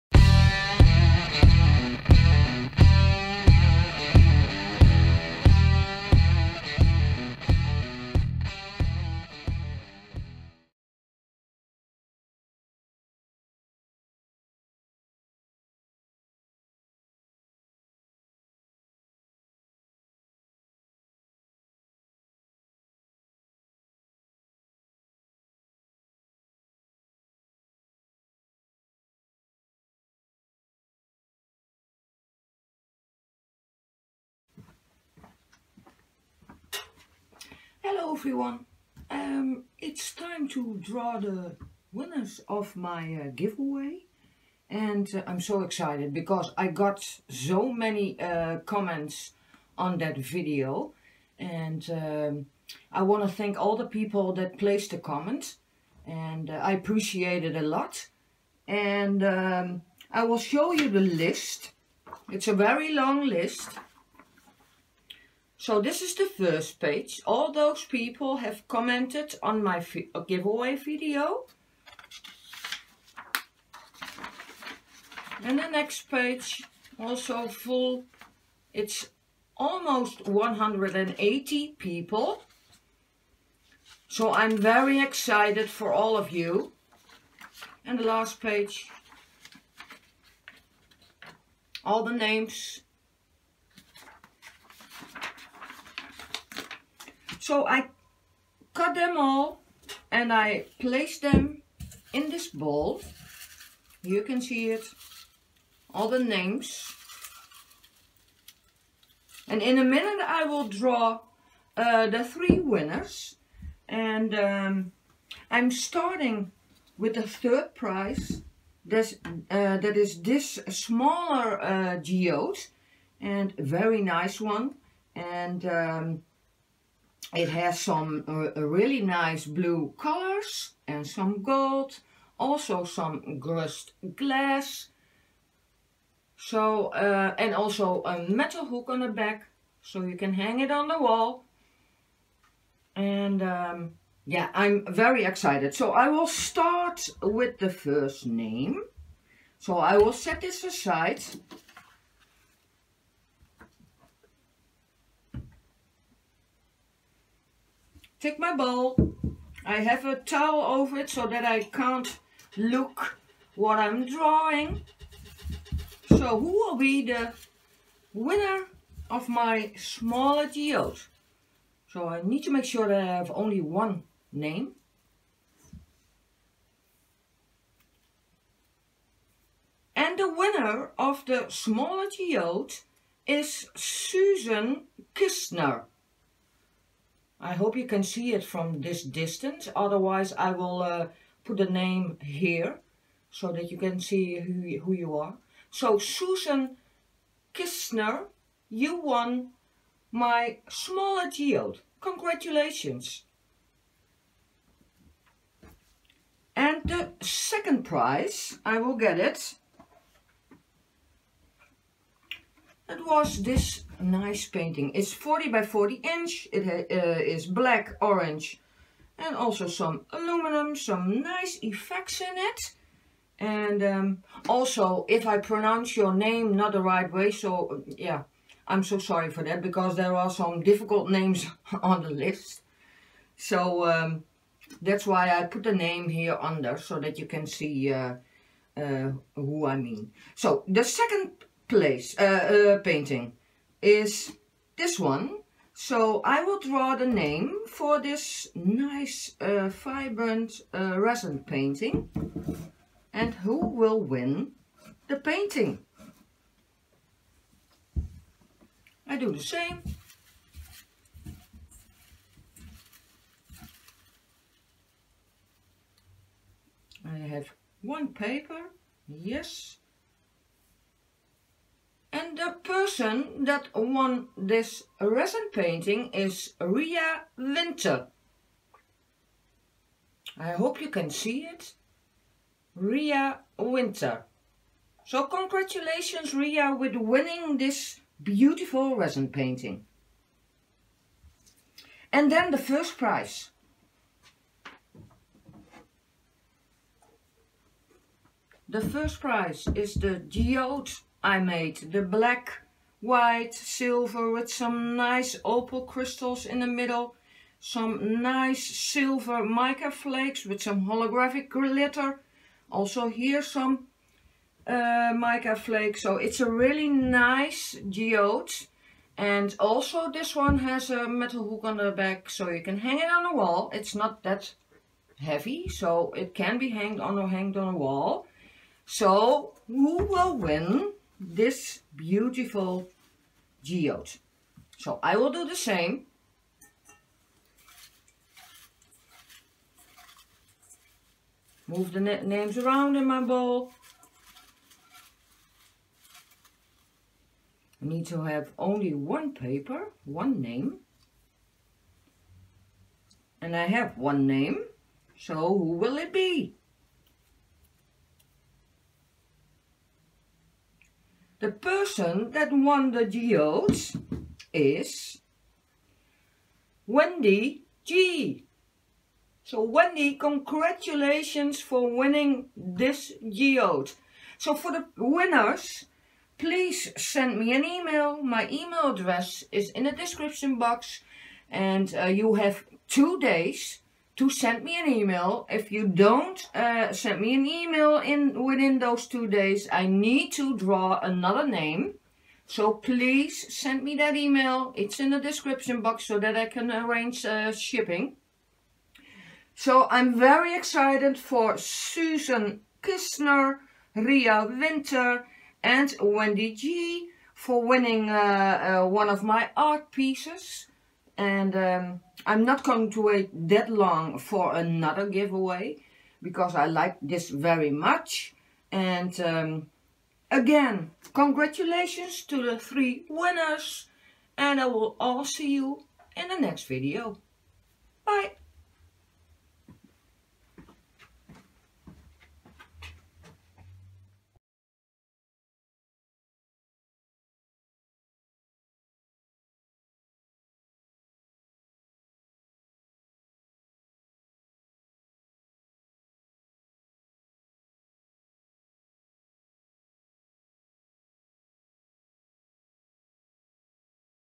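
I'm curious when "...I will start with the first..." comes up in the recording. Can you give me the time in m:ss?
2:25.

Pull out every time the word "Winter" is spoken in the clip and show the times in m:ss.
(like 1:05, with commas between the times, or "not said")
4:37, 4:43, 6:44.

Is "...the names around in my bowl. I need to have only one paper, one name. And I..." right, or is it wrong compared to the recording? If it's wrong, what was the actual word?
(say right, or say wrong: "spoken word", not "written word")
right.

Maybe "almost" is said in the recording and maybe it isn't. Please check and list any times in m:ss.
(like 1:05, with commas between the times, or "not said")
1:19.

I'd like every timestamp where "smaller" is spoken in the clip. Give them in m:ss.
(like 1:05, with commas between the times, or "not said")
2:00, 2:49, 3:01, 3:20.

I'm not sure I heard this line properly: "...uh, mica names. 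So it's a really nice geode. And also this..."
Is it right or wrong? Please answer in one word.
wrong.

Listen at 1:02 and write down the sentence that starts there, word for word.
It's a very long list so this is the first page.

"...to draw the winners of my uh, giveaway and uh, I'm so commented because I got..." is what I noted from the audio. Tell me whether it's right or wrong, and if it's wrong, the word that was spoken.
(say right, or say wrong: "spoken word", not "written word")
wrong: "excited", not "commented".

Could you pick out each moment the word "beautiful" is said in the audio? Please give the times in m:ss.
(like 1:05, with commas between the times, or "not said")
4:48, 5:31.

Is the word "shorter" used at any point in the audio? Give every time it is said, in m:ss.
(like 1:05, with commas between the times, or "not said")
not said.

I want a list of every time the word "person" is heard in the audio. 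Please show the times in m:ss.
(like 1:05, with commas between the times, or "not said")
4:32, 6:01.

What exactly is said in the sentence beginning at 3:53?
So um, that's why I put the name here under so that you can see uh, uh, who I mean.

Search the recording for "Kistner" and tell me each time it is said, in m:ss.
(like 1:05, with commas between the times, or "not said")
3:05, 3:17, 6:42.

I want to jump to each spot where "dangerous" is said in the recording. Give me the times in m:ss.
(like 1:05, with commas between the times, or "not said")
not said.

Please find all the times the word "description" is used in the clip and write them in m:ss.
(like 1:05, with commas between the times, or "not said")
6:19, 6:35.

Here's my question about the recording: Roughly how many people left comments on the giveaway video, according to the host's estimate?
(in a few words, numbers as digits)
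180.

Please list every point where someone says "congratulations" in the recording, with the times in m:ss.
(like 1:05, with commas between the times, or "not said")
3:21, 4:45, 6:10, 7:01.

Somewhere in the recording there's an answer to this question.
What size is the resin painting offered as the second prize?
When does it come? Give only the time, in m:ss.
3:35.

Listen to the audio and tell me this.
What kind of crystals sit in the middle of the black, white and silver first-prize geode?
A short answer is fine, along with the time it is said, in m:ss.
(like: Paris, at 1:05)
Opal crystals, at 5:05.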